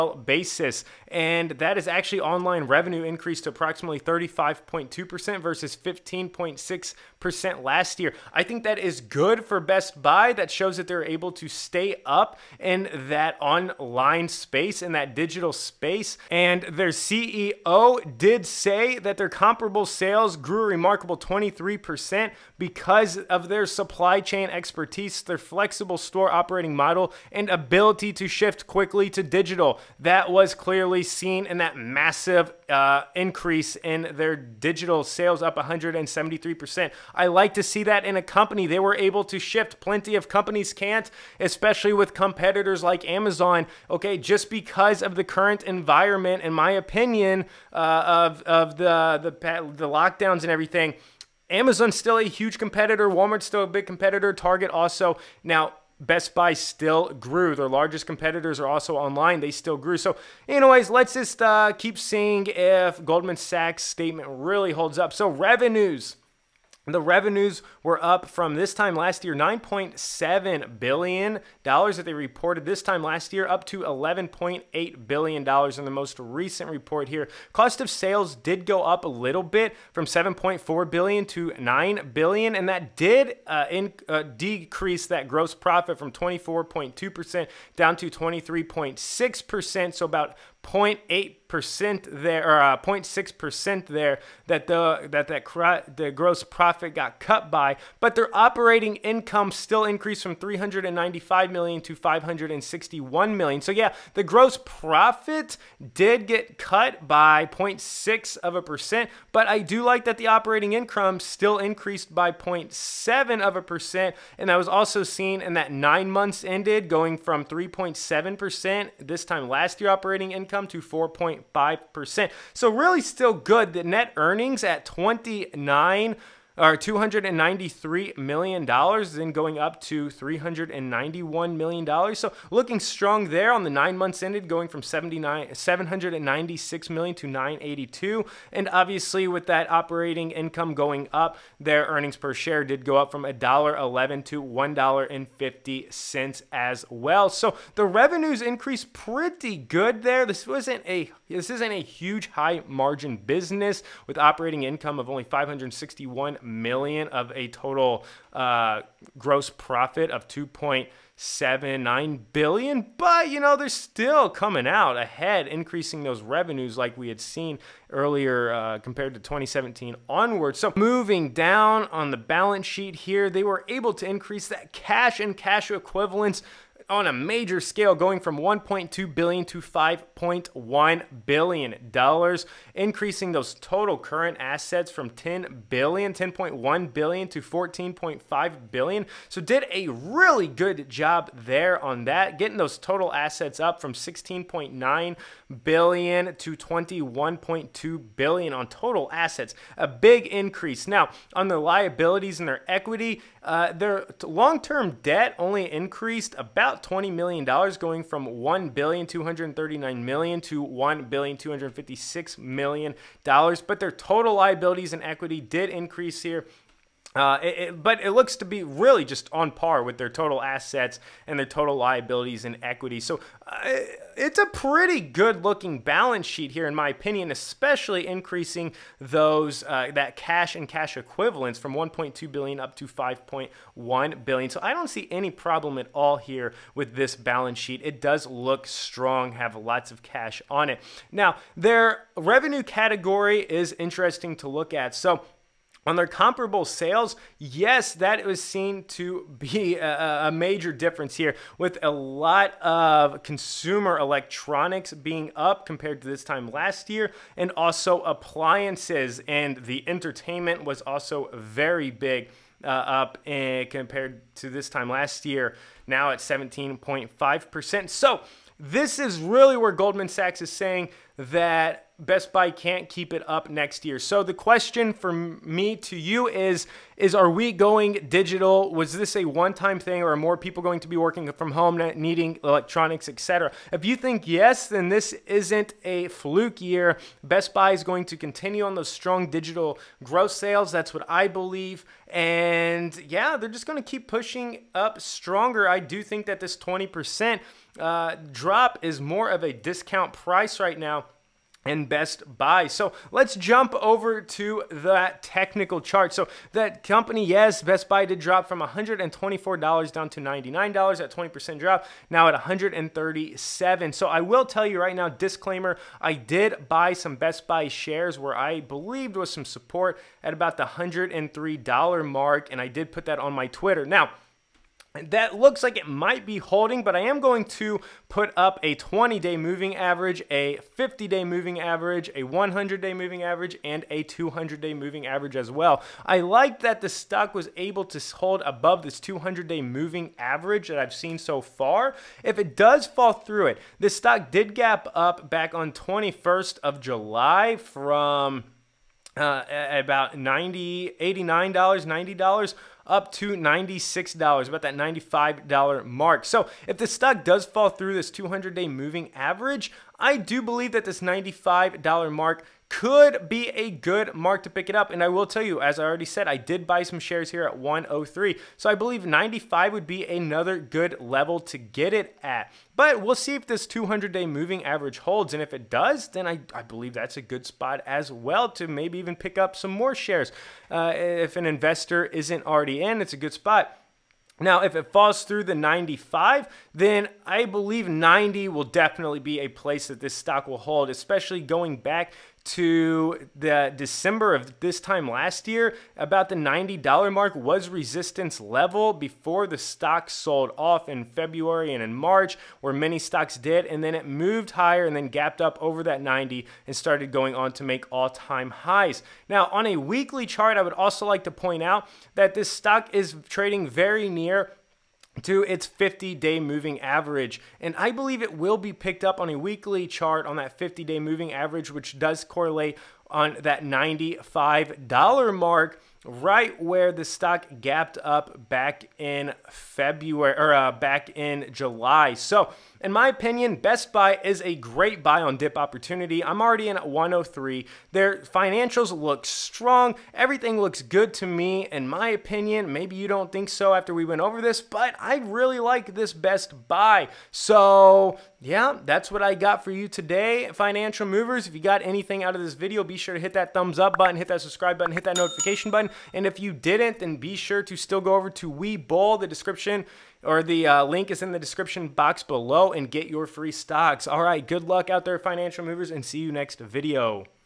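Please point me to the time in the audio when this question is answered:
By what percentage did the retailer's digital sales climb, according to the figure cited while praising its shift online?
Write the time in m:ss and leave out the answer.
0:35.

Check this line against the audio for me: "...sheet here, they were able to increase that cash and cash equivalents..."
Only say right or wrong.
right.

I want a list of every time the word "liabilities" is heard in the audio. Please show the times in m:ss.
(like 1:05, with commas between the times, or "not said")
3:21, 3:34, 3:41.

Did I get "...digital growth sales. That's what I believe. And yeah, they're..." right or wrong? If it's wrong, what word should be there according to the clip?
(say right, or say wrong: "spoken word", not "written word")
right.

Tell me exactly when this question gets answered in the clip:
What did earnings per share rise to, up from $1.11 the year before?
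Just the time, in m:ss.
2:24.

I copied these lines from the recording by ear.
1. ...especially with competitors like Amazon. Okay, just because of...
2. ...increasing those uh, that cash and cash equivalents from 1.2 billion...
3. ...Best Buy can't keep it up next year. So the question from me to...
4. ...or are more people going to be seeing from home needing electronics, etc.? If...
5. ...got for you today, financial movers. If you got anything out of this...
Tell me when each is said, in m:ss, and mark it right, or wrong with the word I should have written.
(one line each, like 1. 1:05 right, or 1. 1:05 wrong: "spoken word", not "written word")
1. 0:41 right
2. 3:48 right
3. 4:31 right
4. 4:40 wrong: "working", not "seeing"
5. 7:29 right.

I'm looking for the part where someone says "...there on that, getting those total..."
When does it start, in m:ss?
3:11.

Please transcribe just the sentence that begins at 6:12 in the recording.
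But we'll see if this 200 day moving average holds.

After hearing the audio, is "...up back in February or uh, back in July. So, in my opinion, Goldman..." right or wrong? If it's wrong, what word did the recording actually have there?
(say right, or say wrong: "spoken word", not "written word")
wrong: "Best", not "Goldman".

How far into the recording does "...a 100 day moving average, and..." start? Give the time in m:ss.
5:32.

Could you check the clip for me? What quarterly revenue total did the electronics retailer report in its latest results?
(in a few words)
$11.8 billion.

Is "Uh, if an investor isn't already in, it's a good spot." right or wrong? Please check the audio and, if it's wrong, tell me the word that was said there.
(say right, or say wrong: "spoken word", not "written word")
right.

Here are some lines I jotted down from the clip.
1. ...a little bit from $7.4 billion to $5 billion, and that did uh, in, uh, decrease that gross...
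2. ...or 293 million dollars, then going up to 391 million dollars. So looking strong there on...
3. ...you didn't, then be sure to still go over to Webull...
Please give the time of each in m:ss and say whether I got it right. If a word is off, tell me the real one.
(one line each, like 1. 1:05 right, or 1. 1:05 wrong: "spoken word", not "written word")
1. 1:19 wrong: "9", not "5"
2. 2:06 right
3. 7:36 right.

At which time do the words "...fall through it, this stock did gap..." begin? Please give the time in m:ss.
5:42.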